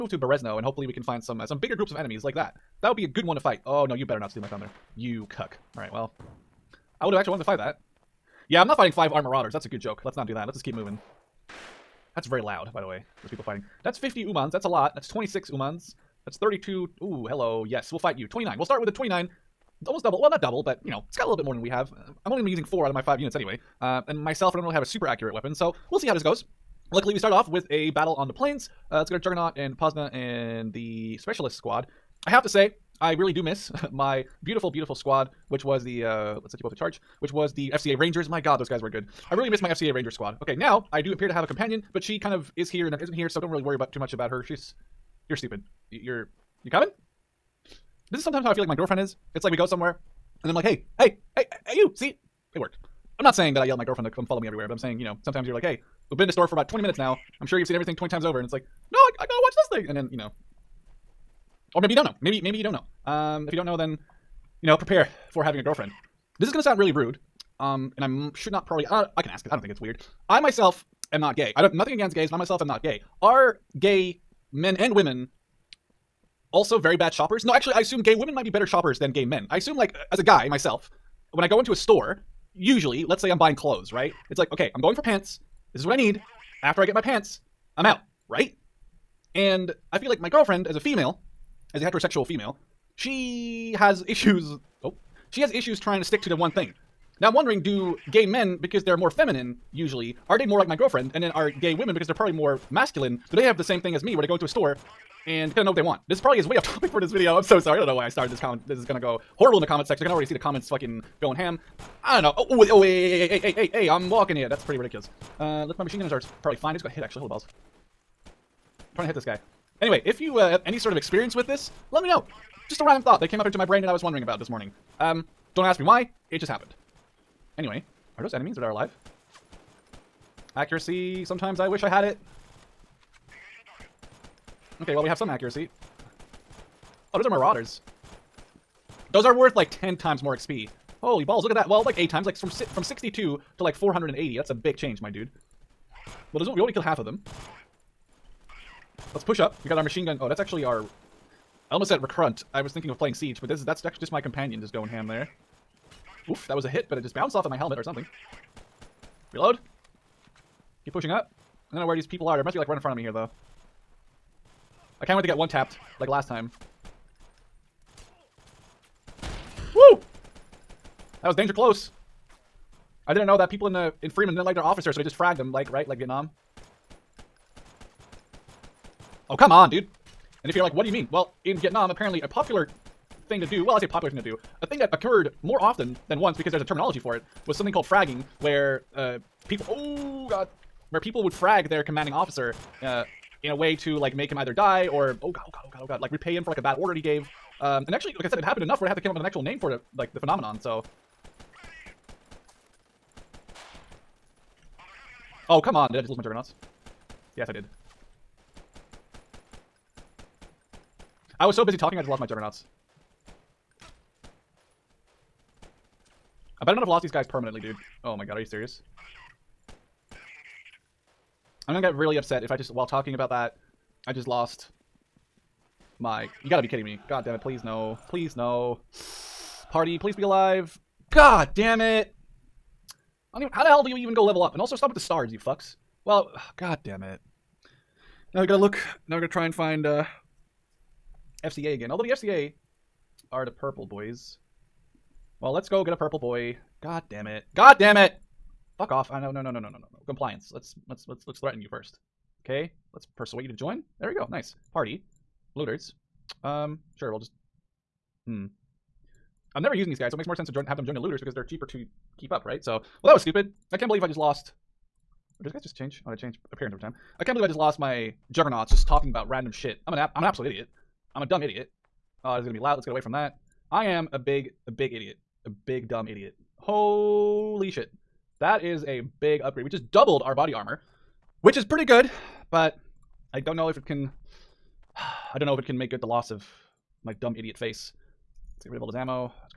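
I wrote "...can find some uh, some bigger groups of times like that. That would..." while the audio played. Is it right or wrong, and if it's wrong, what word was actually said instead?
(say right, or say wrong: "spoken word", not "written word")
wrong: "enemies", not "times".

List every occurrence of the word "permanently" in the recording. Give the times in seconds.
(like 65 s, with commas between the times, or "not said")
217 s.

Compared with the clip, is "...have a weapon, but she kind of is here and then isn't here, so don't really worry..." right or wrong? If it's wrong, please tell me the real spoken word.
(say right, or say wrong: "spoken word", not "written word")
wrong: "companion", not "weapon".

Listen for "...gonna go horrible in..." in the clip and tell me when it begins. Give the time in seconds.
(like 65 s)
108 s.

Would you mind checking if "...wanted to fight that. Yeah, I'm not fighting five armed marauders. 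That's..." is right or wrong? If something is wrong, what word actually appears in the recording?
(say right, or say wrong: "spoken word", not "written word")
right.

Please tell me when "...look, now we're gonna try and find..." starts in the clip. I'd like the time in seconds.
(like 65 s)
238 s.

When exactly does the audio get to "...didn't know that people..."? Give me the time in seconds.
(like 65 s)
173 s.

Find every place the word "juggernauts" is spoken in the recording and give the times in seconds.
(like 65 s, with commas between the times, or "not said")
29 s, 206 s, 212 s, 268 s.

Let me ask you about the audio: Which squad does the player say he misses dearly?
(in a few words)
FCA Rangers.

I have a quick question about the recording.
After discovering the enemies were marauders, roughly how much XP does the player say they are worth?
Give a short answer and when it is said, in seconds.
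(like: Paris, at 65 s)
480, at 143 s.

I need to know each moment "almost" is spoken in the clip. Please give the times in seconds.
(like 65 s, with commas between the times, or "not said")
19 s, 151 s.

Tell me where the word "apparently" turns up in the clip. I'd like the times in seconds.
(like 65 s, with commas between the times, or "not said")
181 s.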